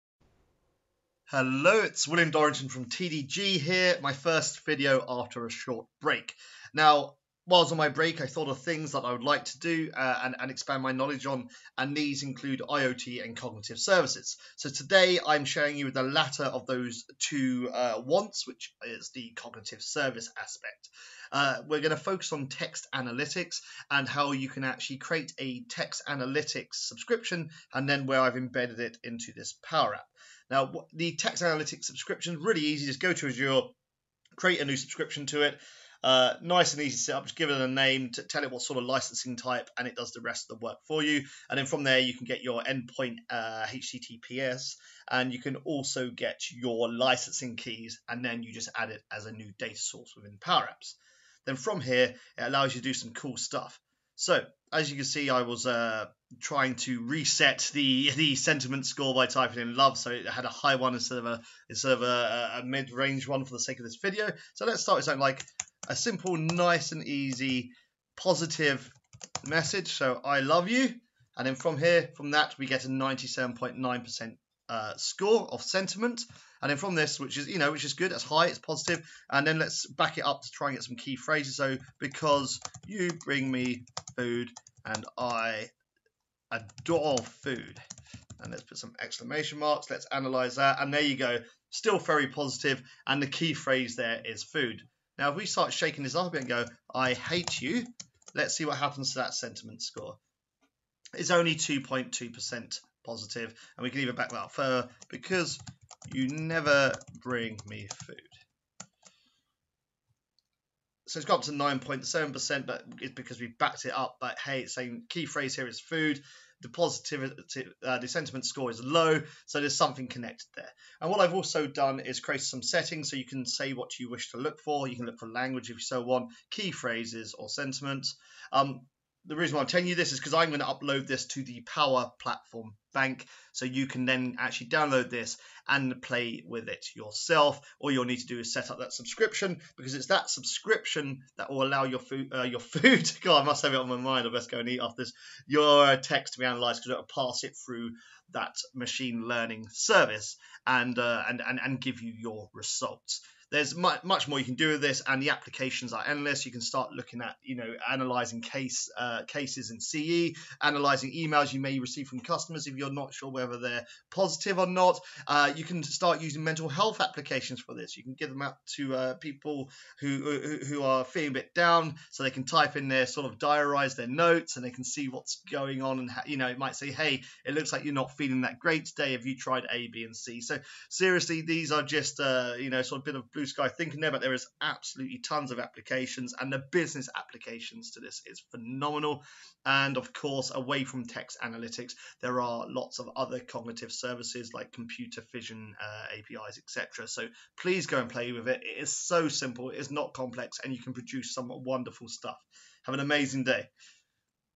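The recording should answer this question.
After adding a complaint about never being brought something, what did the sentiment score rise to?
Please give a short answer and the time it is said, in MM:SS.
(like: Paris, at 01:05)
9.7%, at 01:51.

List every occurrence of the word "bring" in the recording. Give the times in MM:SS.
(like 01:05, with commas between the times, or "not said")
01:23, 01:47.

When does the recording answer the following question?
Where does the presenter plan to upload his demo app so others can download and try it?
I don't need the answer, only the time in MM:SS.
02:11.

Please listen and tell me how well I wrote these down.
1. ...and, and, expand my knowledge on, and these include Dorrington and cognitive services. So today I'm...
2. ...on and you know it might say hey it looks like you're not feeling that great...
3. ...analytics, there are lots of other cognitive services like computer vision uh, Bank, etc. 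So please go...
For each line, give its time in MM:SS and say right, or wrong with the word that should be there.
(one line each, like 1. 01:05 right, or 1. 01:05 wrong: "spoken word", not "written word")
1. 00:10 wrong: "IoT", not "Dorrington"
2. 02:55 right
3. 03:11 wrong: "APIs", not "Bank".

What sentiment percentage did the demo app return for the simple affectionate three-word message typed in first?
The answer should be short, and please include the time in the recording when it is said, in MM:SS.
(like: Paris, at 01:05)
97.9%, at 01:12.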